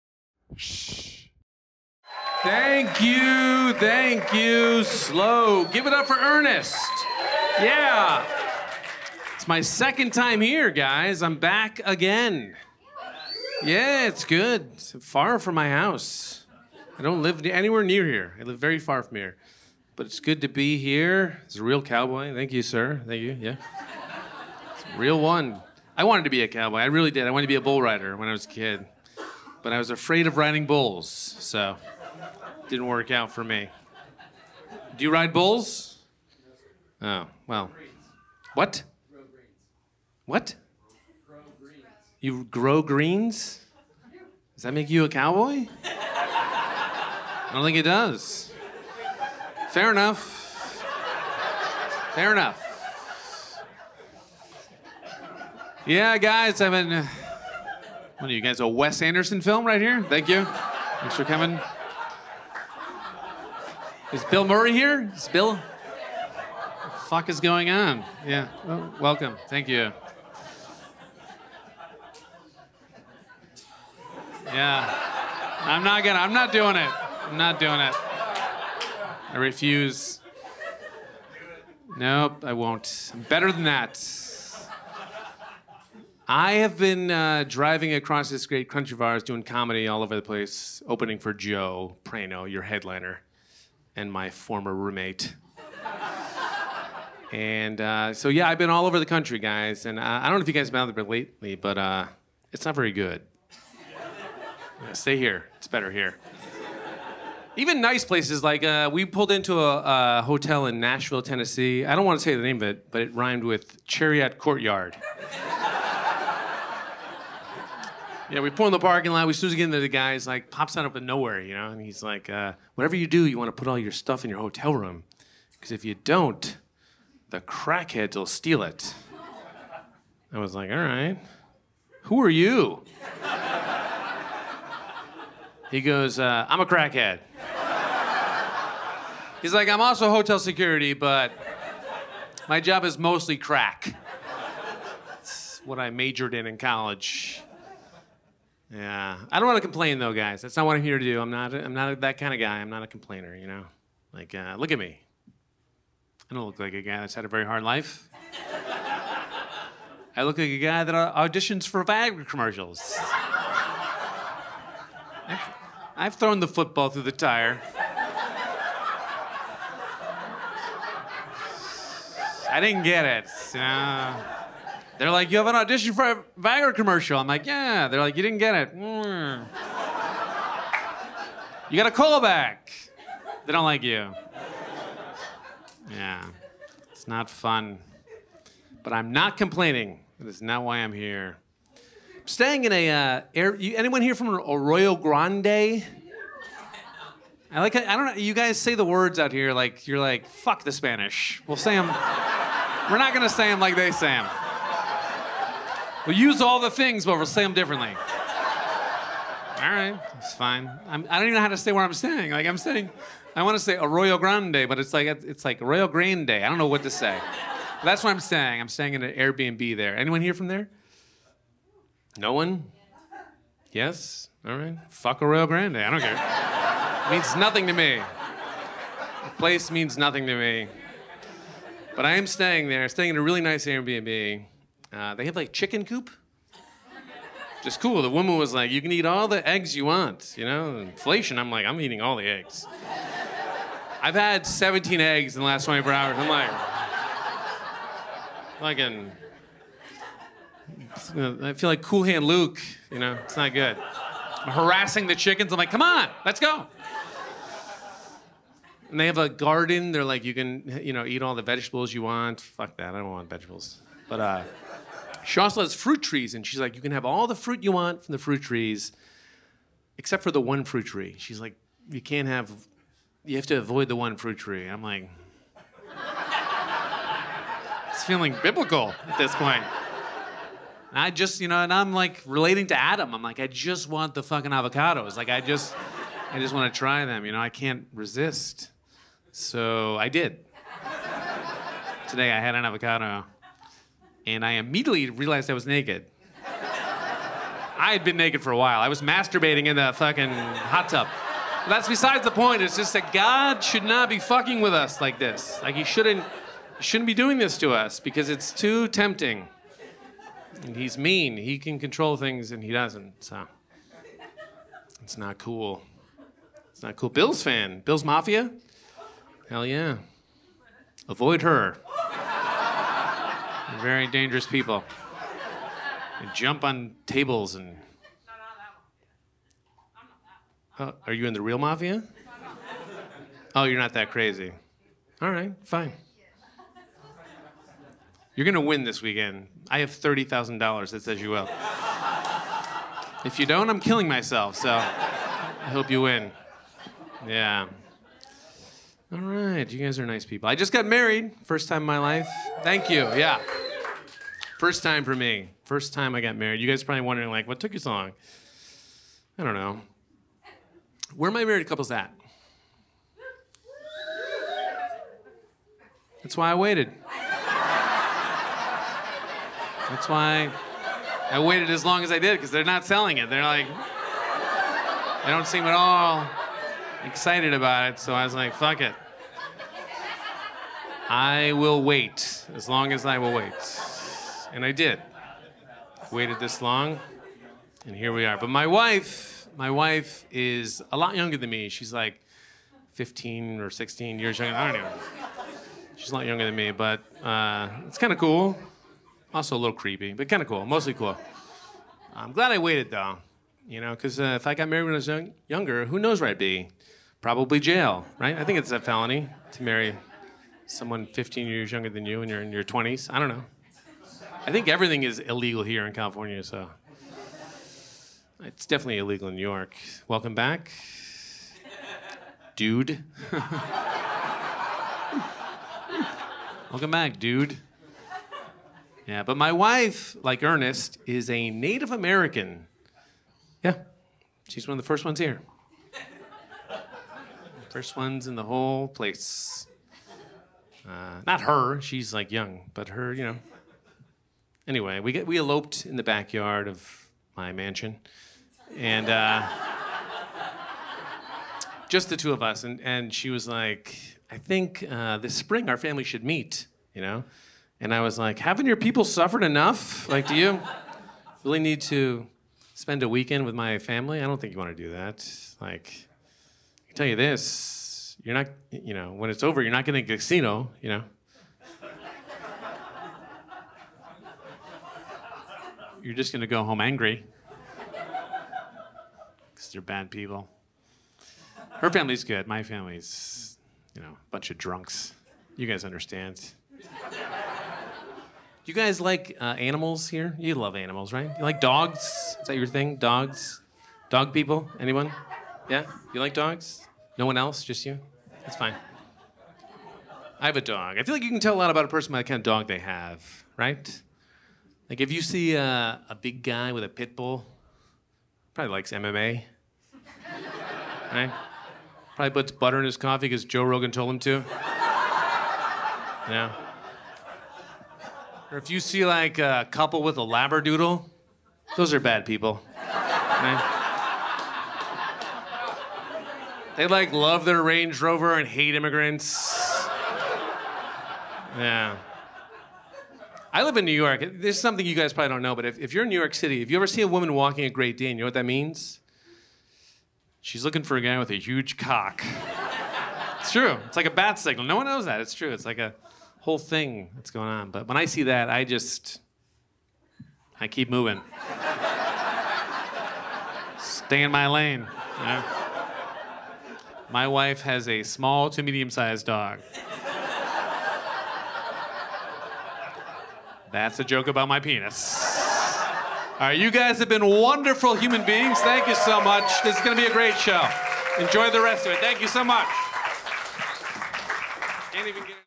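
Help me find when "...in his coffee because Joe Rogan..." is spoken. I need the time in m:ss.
8:32.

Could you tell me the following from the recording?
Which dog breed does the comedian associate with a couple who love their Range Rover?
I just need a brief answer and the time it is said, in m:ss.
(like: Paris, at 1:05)
Labradoodle, at 8:40.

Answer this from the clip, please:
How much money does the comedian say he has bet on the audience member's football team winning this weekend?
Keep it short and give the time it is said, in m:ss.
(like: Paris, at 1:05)
$30,000, at 5:39.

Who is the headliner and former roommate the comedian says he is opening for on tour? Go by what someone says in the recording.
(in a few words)
Joe Prano.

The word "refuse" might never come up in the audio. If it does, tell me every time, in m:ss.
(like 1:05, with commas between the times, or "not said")
1:19.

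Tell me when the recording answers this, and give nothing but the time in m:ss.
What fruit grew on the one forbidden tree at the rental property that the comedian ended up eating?
4:44.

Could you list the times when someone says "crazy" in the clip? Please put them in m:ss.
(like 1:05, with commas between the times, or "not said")
5:34.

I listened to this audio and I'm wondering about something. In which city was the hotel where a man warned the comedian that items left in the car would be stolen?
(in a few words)
Nashville.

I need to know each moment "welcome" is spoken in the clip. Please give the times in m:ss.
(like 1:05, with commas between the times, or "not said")
1:09, 7:00, 7:06.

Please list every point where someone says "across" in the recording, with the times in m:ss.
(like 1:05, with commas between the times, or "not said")
1:27.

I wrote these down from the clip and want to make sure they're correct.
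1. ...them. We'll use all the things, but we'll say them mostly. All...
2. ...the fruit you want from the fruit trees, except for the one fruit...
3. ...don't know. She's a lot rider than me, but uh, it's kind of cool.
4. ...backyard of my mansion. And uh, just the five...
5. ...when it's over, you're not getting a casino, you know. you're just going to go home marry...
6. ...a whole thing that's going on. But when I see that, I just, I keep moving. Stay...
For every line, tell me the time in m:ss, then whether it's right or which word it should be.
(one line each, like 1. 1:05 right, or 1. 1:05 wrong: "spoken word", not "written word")
1. 3:24 wrong: "differently", not "mostly"
2. 4:27 right
3. 6:34 wrong: "younger", not "rider"
4. 7:26 wrong: "two", not "five"
5. 7:49 wrong: "angry", not "marry"
6. 9:05 right.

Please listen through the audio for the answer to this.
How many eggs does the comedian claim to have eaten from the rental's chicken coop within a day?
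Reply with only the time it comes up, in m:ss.
4:04.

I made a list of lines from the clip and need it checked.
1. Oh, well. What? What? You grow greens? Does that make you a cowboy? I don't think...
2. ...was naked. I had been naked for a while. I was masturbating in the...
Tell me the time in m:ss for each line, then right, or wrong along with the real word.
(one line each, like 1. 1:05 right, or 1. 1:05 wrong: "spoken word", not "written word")
1. 0:37 right
2. 4:55 right.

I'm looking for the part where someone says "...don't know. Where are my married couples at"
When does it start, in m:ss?
5:59.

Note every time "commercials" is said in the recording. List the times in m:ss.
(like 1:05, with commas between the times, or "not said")
2:42, 2:56.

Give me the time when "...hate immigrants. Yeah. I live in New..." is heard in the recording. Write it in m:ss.
8:48.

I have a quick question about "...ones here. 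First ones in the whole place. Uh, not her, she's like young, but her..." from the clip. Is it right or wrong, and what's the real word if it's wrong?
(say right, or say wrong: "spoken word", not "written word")
right.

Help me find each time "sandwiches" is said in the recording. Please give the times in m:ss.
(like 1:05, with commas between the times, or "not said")
not said.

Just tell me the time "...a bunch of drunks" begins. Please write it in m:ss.
8:04.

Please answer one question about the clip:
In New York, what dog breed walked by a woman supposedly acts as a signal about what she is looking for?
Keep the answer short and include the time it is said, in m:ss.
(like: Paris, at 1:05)
Great Dane, at 8:57.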